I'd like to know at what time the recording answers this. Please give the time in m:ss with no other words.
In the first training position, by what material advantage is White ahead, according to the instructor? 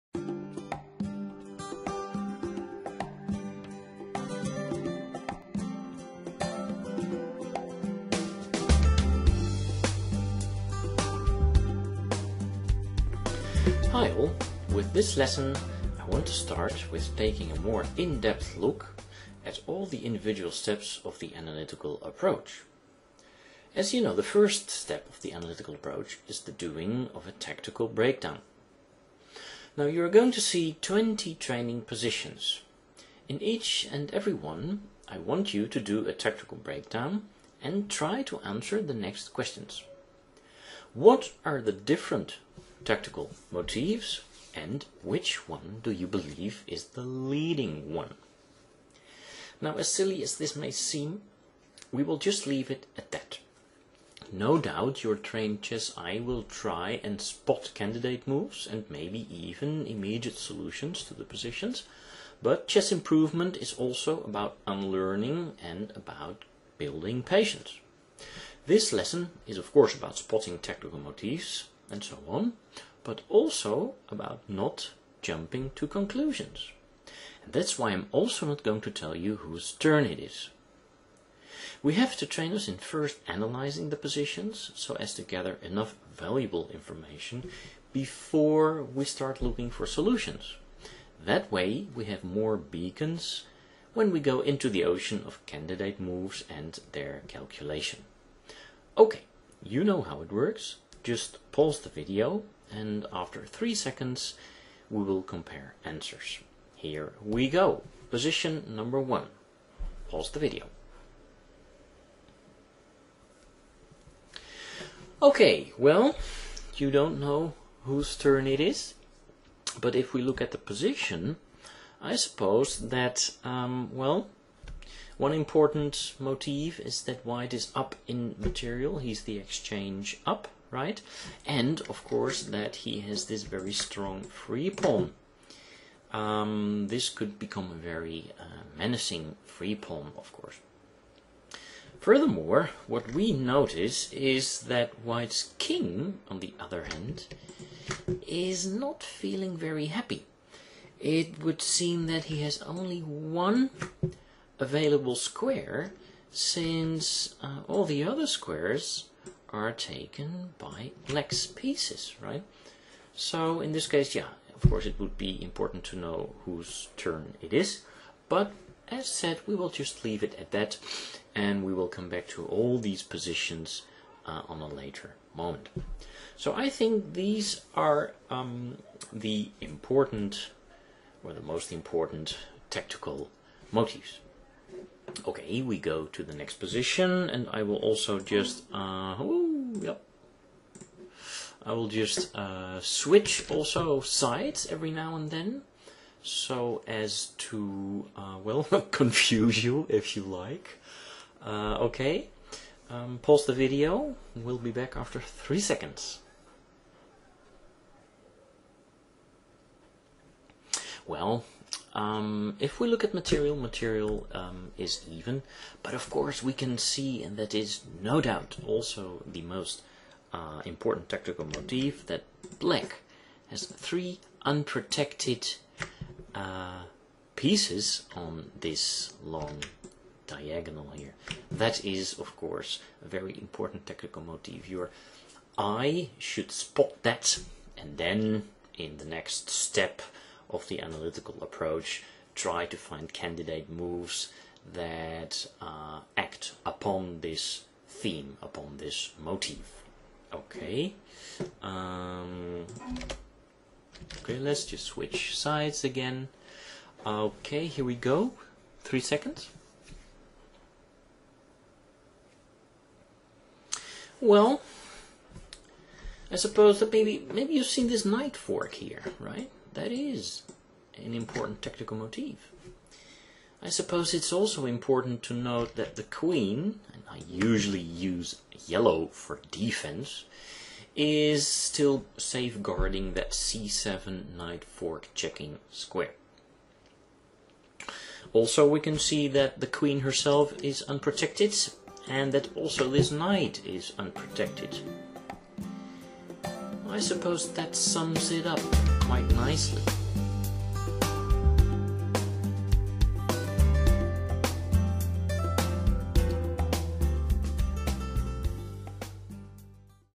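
2:09.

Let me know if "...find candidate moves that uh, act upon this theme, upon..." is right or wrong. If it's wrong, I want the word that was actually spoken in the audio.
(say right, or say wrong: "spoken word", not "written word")
right.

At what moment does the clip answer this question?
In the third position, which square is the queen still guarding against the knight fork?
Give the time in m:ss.
4:43.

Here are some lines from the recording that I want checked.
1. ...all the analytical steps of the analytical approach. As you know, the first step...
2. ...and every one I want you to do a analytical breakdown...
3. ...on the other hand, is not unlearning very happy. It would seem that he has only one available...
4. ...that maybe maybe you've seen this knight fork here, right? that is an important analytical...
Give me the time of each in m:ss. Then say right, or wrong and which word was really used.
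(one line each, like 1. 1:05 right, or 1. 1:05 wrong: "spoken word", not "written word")
1. 0:19 wrong: "individual", not "analytical"
2. 0:33 wrong: "tactical", not "analytical"
3. 2:26 wrong: "feeling", not "unlearning"
4. 4:26 wrong: "tactical", not "analytical".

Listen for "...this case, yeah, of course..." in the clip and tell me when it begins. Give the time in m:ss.
2:43.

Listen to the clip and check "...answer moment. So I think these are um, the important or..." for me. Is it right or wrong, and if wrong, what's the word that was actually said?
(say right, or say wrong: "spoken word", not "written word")
wrong: "later", not "answer".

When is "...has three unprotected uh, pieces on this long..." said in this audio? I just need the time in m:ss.
3:43.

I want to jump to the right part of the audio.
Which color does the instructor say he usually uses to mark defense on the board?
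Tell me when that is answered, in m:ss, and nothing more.
4:38.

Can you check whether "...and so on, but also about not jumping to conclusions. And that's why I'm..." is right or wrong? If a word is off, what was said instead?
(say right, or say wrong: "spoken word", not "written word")
right.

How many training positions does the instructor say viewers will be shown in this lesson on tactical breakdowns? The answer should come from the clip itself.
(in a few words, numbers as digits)
20.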